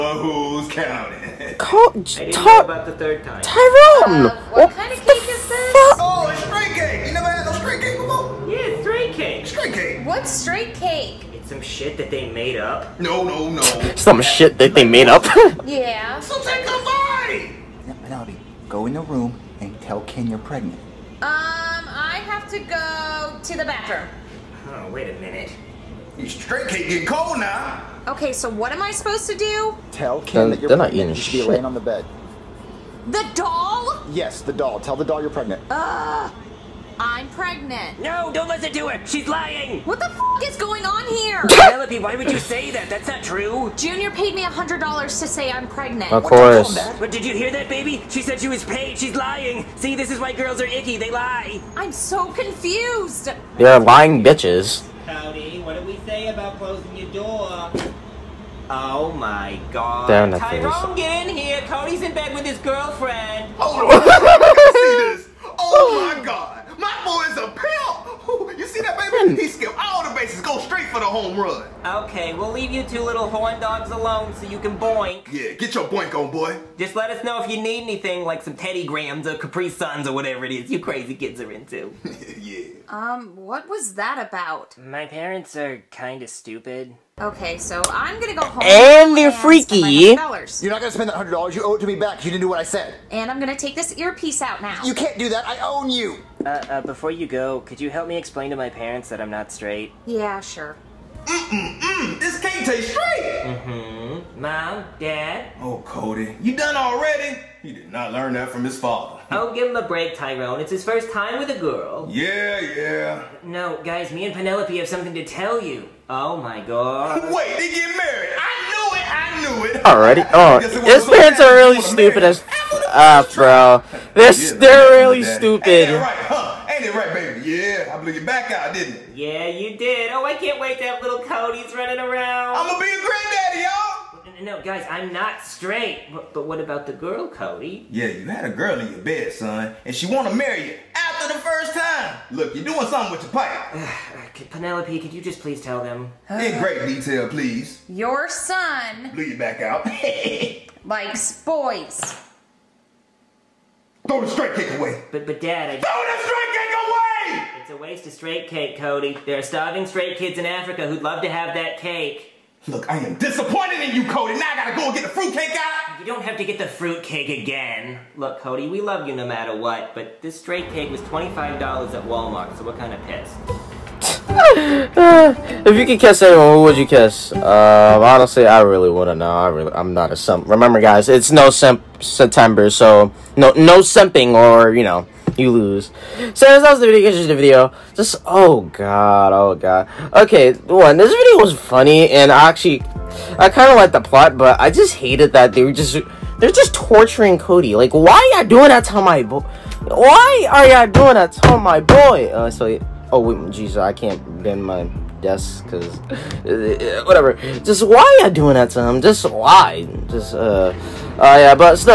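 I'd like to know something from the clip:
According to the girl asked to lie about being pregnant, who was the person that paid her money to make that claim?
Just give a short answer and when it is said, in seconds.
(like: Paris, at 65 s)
Junior, at 43 s.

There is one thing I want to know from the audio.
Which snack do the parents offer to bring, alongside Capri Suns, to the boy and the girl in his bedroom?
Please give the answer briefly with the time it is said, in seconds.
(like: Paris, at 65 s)
Teddy Grahams, at 78 s.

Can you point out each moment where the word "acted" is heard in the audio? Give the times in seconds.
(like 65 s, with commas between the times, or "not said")
not said.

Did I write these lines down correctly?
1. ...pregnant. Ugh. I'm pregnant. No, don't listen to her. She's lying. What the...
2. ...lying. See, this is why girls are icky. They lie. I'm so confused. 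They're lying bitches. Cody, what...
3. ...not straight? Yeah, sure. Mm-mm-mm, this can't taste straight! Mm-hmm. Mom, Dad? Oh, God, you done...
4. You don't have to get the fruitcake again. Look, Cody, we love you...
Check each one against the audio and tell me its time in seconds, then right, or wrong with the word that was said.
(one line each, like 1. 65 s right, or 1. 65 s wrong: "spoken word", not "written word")
1. 35 s right
2. 49 s right
3. 99 s wrong: "Cody", not "God"
4. 165 s right.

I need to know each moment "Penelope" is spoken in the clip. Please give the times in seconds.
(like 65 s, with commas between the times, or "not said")
18 s, 41 s, 114 s, 144 s.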